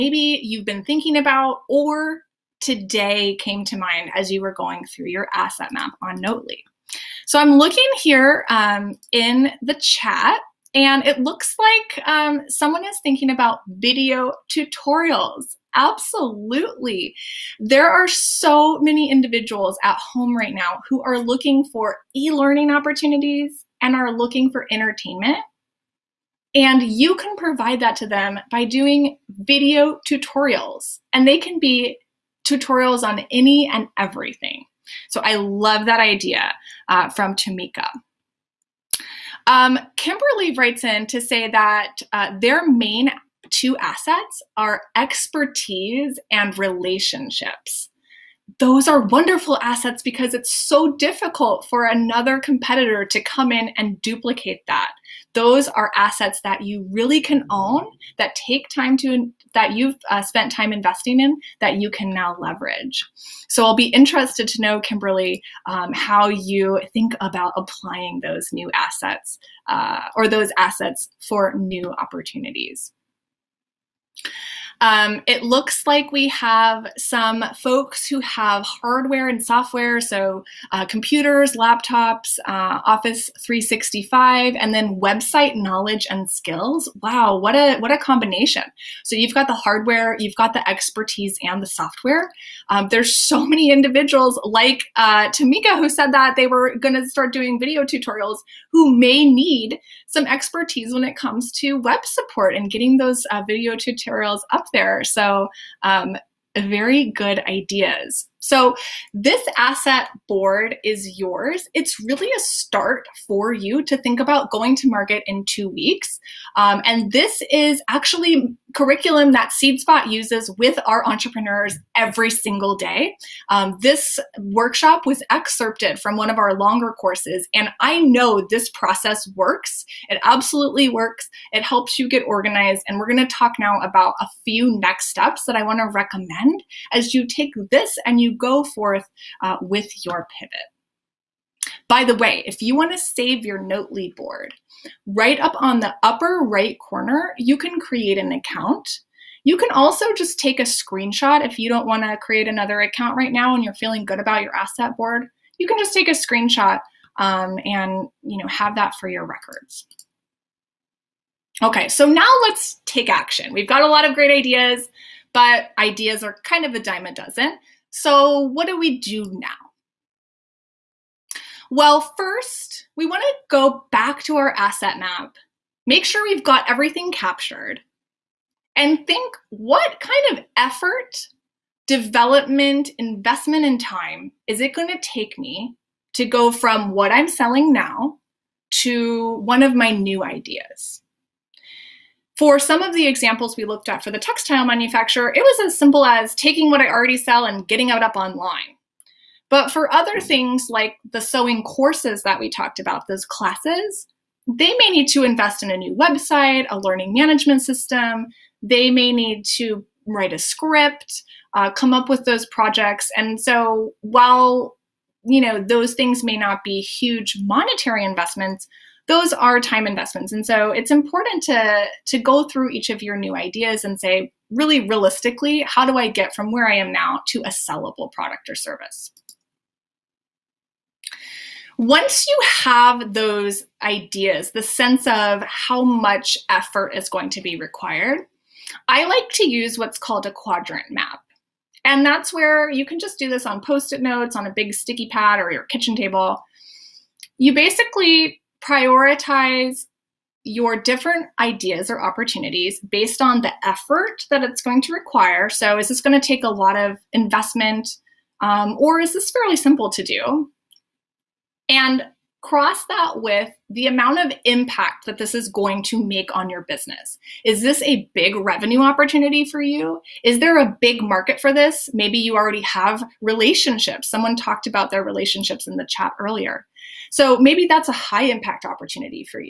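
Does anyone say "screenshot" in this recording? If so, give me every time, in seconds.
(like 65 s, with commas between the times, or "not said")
150 s, 156 s.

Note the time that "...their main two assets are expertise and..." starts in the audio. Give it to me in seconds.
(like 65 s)
42 s.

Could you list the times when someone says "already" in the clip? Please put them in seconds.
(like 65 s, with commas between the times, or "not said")
196 s, 272 s.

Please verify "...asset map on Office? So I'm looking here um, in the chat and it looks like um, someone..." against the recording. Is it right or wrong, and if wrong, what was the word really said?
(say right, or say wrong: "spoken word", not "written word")
wrong: "Notely", not "Office".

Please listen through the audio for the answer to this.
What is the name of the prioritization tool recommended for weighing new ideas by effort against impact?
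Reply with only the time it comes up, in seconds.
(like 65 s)
240 s.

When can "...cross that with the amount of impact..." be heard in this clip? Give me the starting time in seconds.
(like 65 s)
262 s.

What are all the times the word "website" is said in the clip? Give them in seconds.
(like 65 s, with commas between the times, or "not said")
85 s, 205 s.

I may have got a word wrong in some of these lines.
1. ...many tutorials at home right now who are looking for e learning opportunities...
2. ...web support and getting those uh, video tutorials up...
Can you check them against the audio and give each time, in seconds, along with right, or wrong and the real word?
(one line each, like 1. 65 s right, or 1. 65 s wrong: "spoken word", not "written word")
1. 18 s wrong: "individuals", not "tutorials"
2. 101 s right.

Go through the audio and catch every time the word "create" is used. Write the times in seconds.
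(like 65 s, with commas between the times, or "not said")
147 s, 152 s.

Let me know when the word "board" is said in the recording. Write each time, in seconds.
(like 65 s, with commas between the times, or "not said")
110 s, 144 s, 154 s.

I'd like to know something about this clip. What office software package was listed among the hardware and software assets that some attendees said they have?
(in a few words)
Office 365.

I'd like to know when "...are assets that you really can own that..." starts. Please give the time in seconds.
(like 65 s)
55 s.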